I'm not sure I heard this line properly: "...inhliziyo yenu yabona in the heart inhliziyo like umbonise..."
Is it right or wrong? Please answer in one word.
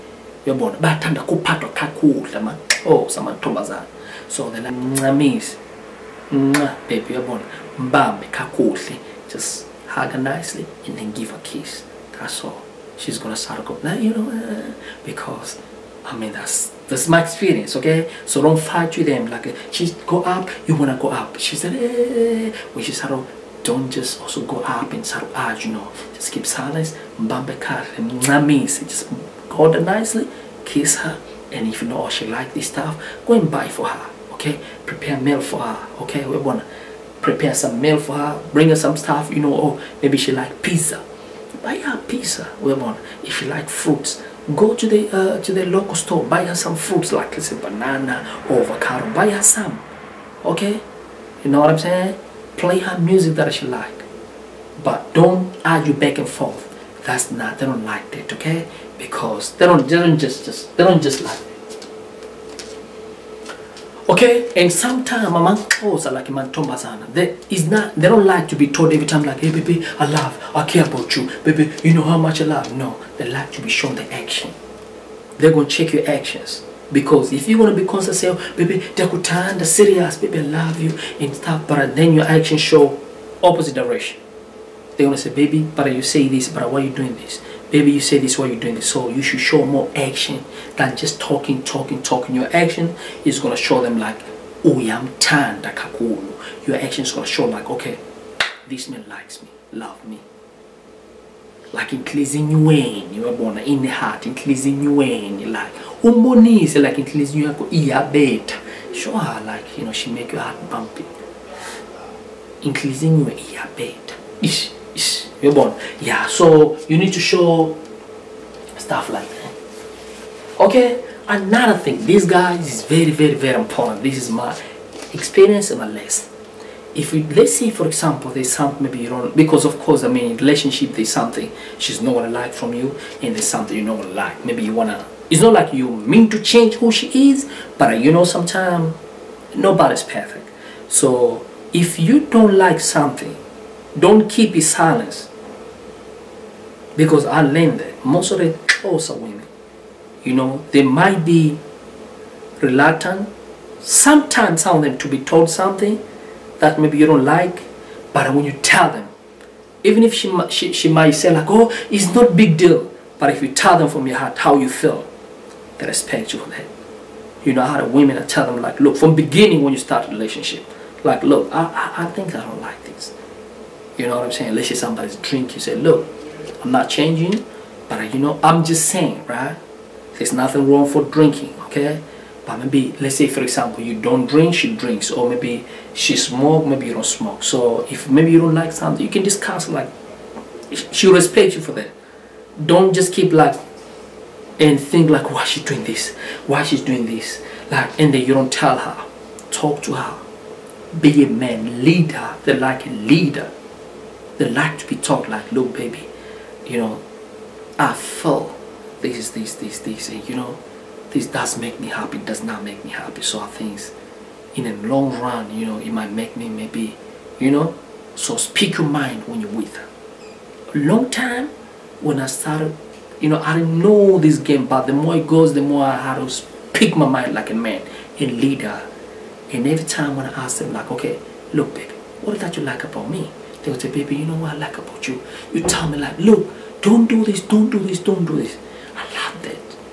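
right.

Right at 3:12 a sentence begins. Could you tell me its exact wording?
Don't just keep like and think like why she's doing this, why she's doing this.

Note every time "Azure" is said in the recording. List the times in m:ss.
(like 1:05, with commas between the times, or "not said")
not said.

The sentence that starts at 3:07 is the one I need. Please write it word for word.
So if maybe you don't like something, you can discuss.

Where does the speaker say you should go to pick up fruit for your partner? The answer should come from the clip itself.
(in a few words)
the local store.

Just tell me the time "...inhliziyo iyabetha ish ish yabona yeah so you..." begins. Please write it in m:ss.
1:52.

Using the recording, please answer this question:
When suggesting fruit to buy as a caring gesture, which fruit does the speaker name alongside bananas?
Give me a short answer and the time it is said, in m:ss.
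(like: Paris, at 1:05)
avocado, at 0:48.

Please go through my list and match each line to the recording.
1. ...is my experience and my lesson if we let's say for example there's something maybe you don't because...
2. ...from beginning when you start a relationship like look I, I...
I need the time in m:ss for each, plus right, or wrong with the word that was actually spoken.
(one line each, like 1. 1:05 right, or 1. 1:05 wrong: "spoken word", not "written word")
1. 2:04 right
2. 2:48 right.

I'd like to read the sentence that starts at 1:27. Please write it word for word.
Baby, you say this, why are you doing this?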